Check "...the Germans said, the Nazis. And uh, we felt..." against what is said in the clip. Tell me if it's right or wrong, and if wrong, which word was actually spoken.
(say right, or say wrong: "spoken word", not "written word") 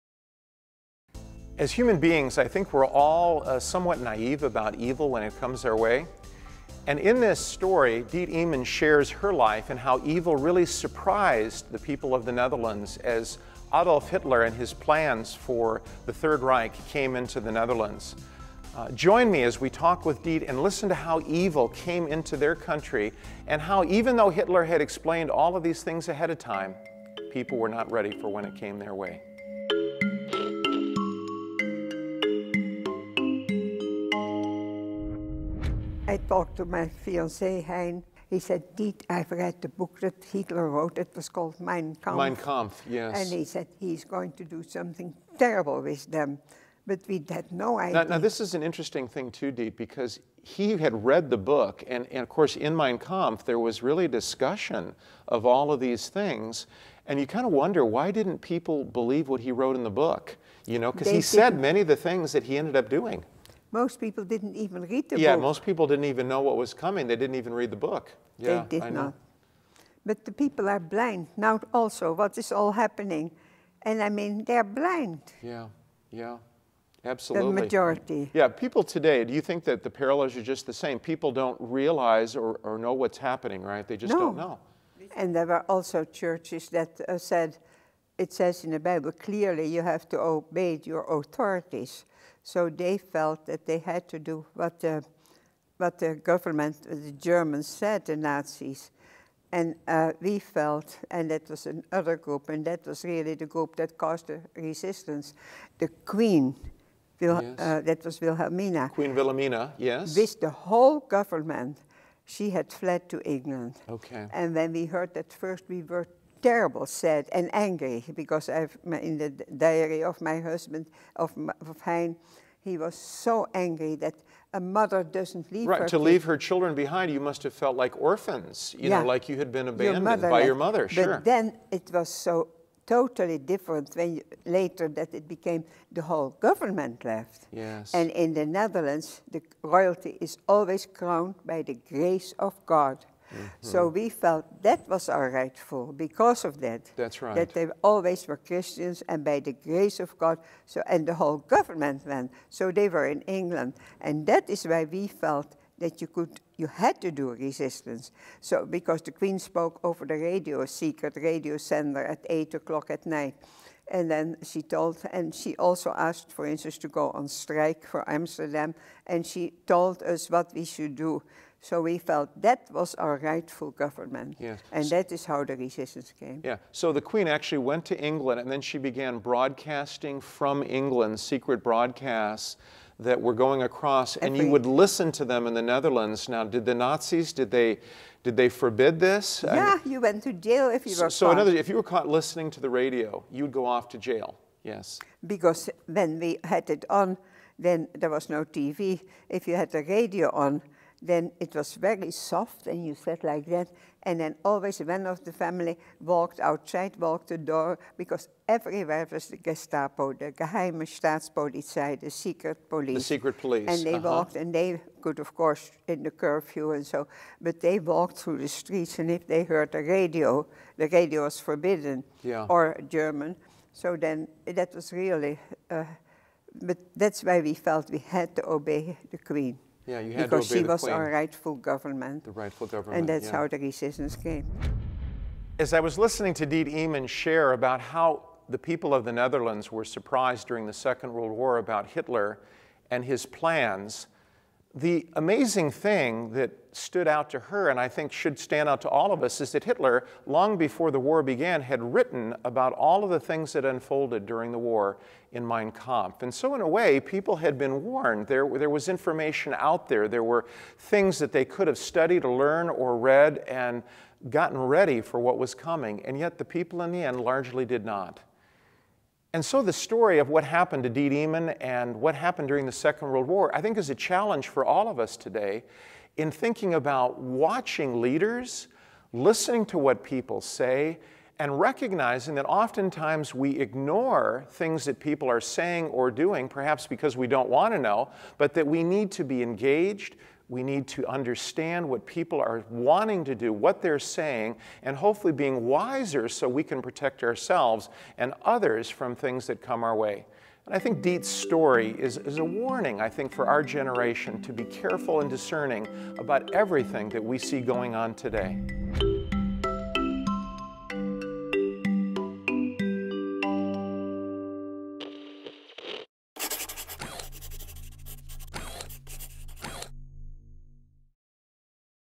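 right.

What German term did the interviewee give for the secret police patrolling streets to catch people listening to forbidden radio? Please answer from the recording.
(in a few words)
geheime Staatspolizei.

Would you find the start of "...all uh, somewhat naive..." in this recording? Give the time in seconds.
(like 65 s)
2 s.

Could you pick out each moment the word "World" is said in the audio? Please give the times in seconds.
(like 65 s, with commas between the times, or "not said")
241 s, 273 s.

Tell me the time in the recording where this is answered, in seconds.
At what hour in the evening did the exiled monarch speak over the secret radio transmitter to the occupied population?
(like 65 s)
162 s.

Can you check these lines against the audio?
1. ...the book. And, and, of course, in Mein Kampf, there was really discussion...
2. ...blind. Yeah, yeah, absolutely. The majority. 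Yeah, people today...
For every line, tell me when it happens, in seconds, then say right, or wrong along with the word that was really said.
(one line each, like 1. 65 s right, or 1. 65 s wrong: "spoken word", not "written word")
1. 51 s right
2. 74 s right.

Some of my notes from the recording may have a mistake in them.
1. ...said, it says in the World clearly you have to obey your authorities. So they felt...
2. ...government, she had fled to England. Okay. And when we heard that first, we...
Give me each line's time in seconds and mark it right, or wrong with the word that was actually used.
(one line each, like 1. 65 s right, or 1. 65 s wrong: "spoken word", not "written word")
1. 87 s wrong: "Bible", not "World"
2. 111 s right.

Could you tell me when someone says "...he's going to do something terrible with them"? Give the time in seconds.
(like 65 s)
43 s.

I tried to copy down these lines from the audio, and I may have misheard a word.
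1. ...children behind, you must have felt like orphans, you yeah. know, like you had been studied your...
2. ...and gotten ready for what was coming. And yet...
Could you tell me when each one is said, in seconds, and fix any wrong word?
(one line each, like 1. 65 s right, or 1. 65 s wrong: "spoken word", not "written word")
1. 126 s wrong: "abandoned", not "studied"
2. 263 s right.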